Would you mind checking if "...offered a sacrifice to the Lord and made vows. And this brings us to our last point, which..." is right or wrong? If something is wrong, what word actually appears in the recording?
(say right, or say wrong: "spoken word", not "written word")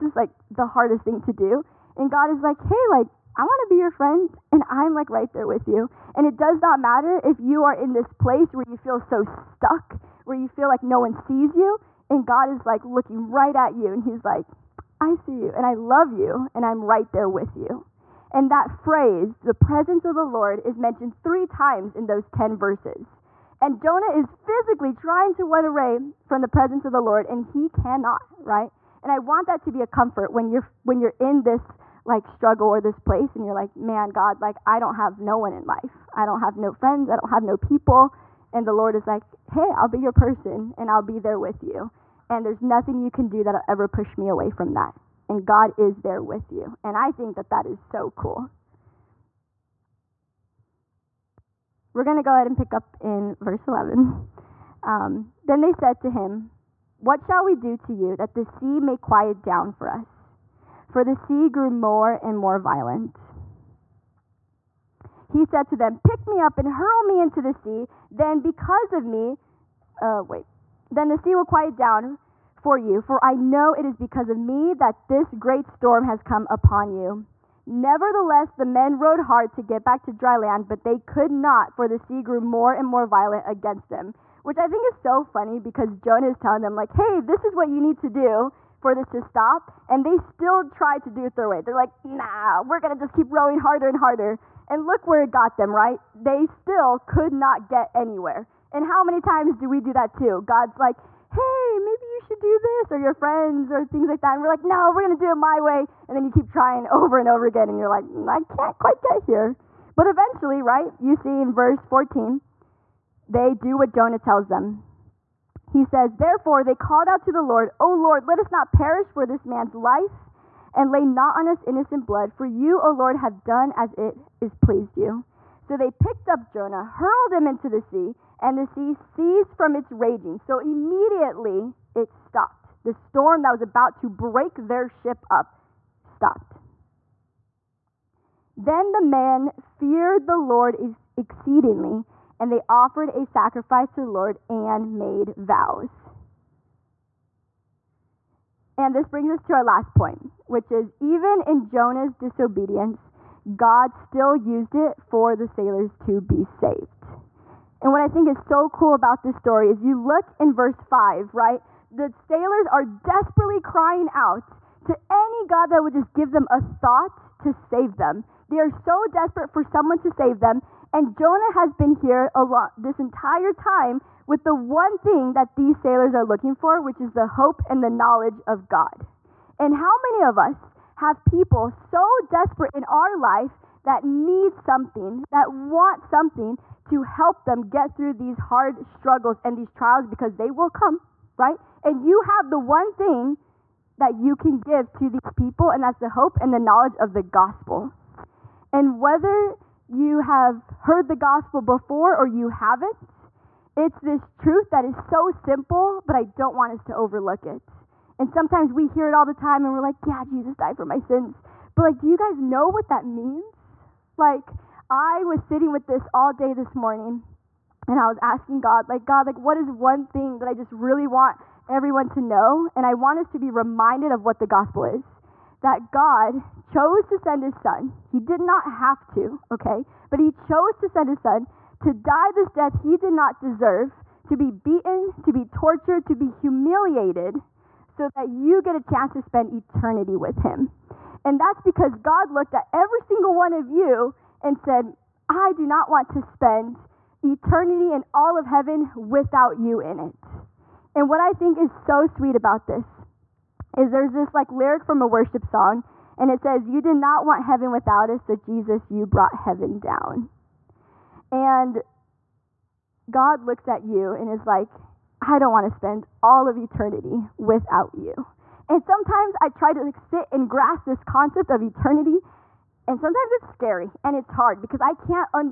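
right.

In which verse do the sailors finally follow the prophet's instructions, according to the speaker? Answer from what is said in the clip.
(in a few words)
14.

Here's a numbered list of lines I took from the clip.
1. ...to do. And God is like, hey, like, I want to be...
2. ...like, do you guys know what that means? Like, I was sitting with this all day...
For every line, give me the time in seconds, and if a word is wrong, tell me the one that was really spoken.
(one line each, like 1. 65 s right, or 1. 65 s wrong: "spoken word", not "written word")
1. 1 s right
2. 211 s right.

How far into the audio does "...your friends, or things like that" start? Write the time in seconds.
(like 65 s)
102 s.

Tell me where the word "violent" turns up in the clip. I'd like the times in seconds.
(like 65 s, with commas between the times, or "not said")
62 s, 83 s.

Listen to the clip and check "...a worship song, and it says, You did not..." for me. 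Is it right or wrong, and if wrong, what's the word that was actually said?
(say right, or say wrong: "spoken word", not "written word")
right.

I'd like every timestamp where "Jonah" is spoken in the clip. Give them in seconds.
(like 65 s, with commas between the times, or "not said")
23 s, 85 s, 113 s, 126 s, 151 s, 171 s.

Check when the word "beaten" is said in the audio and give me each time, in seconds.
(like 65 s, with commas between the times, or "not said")
234 s.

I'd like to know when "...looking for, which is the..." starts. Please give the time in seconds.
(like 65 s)
176 s.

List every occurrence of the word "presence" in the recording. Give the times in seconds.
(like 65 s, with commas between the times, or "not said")
19 s, 26 s.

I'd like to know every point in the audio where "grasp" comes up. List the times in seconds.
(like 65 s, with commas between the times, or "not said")
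270 s.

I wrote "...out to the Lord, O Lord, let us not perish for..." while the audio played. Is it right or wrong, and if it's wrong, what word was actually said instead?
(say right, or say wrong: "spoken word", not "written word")
right.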